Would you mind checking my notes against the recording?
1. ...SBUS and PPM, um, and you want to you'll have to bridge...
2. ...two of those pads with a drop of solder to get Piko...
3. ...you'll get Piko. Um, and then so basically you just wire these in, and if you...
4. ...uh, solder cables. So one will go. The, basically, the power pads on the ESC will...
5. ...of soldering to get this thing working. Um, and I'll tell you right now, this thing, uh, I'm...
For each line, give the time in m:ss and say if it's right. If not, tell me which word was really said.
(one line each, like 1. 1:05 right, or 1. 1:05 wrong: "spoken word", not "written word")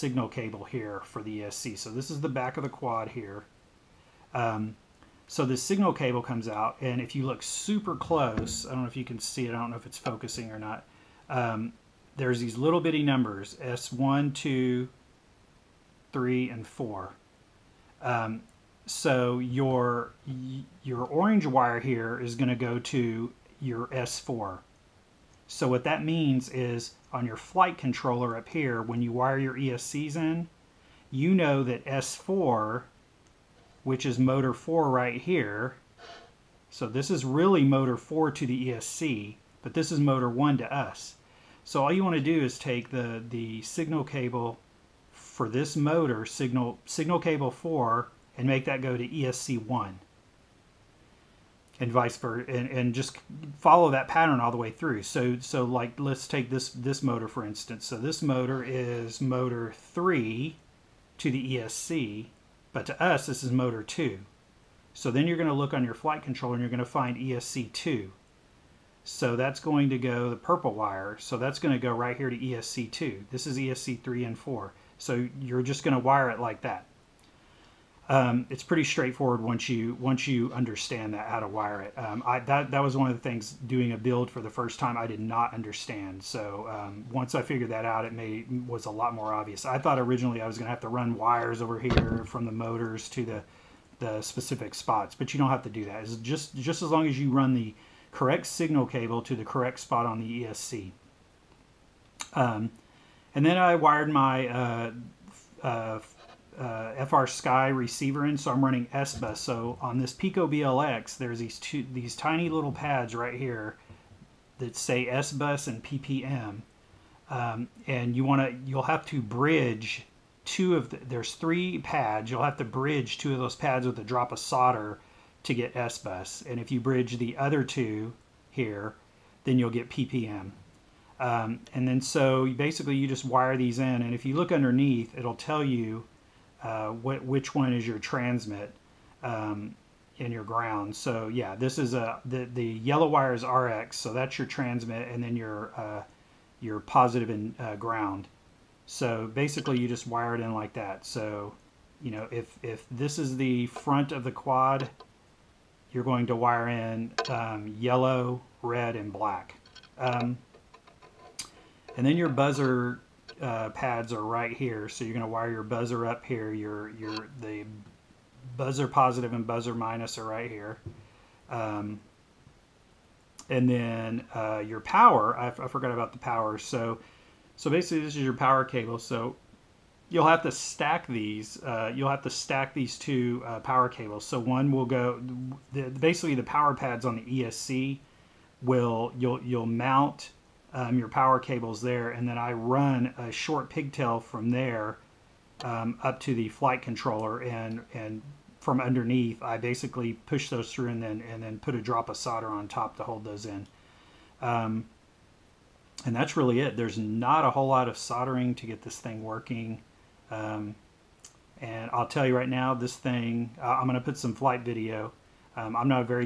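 1. 1:55 right
2. 2:03 wrong: "SBUS", not "Piko"
3. 2:09 wrong: "PPM", not "Piko"
4. 3:03 wrong: "power", not "solder"
5. 3:27 right.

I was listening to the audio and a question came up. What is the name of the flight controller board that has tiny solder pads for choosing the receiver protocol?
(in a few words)
Piko BLX.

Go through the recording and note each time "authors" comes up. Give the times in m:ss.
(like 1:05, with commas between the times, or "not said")
not said.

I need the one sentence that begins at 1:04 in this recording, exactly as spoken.
So then you're going to look on your flight controller and you're going to find ESC2.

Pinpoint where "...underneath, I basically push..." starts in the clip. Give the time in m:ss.
3:18.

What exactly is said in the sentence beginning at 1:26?
So um, once I figured that out, it made was a lot more obvious.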